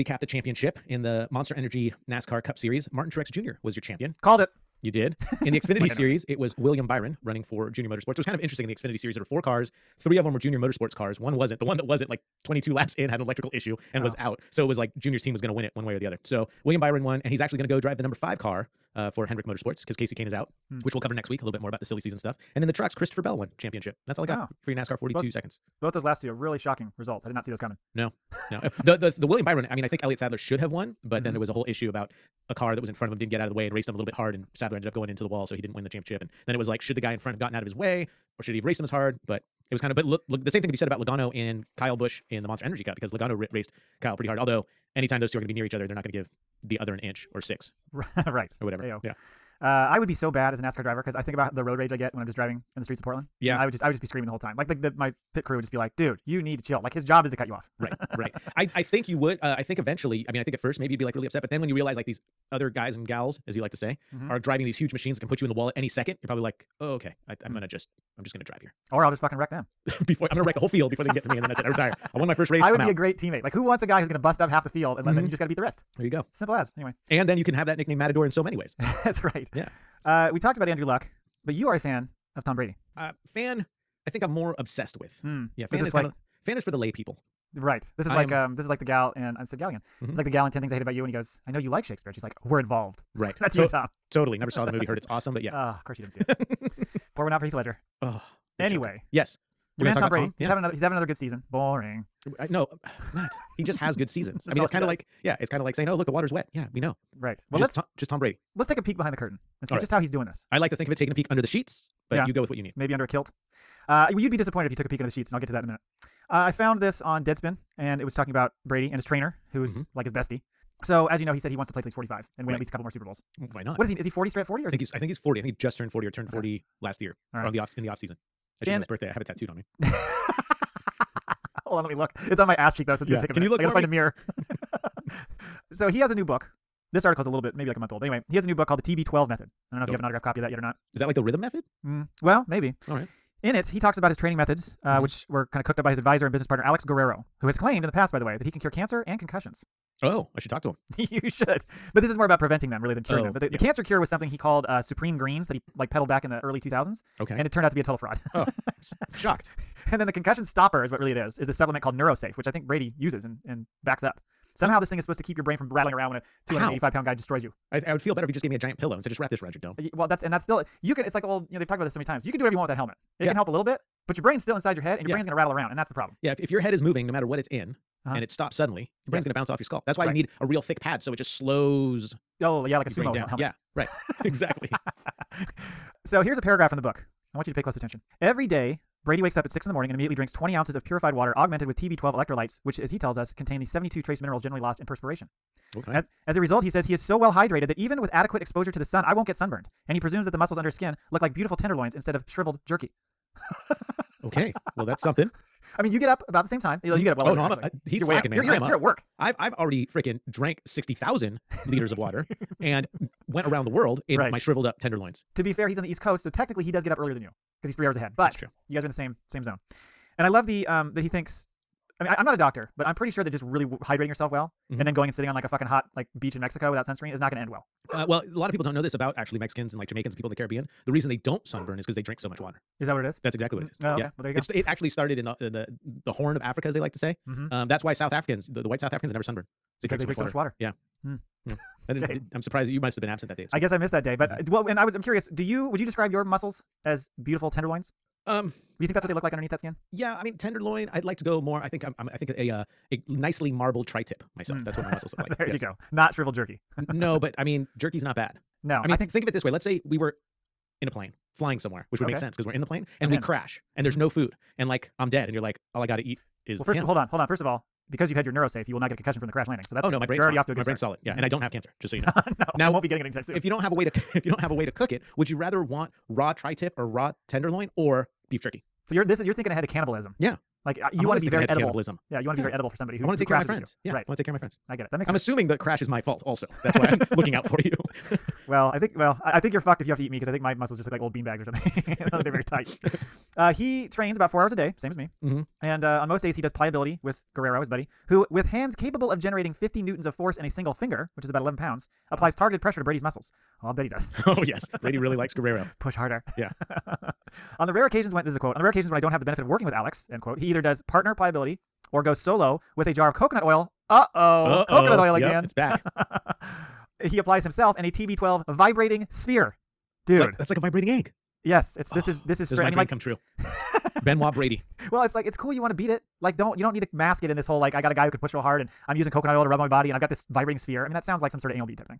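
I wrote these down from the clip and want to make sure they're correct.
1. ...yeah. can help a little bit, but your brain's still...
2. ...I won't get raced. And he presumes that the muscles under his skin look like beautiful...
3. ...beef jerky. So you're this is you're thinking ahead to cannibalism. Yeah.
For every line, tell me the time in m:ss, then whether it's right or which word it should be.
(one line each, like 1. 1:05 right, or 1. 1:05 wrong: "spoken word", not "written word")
1. 2:53 right
2. 3:19 wrong: "sunburned", not "raced"
3. 4:38 right.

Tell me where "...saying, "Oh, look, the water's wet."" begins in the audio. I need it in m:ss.
1:45.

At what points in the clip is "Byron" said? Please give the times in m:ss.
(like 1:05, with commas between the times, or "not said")
0:06, 0:16, 0:29.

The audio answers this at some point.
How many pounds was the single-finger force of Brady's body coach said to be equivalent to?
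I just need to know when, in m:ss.
5:01.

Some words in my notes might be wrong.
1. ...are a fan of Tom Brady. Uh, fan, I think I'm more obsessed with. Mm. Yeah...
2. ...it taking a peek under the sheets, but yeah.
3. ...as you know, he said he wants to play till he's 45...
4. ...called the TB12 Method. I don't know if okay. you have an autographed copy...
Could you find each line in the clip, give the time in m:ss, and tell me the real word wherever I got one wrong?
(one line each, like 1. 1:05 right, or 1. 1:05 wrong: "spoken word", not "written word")
1. 1:21 right
2. 1:50 right
3. 2:01 right
4. 2:18 right.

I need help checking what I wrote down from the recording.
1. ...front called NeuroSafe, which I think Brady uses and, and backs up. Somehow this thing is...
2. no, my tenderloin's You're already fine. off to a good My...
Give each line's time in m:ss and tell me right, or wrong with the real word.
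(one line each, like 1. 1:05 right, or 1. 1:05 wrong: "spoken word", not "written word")
1. 2:41 wrong: "supplement", not "front"
2. 4:29 wrong: "brain", not "tenderloin".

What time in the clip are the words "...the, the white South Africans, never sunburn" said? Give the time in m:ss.
3:58.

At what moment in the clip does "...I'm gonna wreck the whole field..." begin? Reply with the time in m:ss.
1:10.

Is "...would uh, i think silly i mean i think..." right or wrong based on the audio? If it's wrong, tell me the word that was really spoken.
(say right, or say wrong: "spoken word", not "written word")
wrong: "eventually", not "silly".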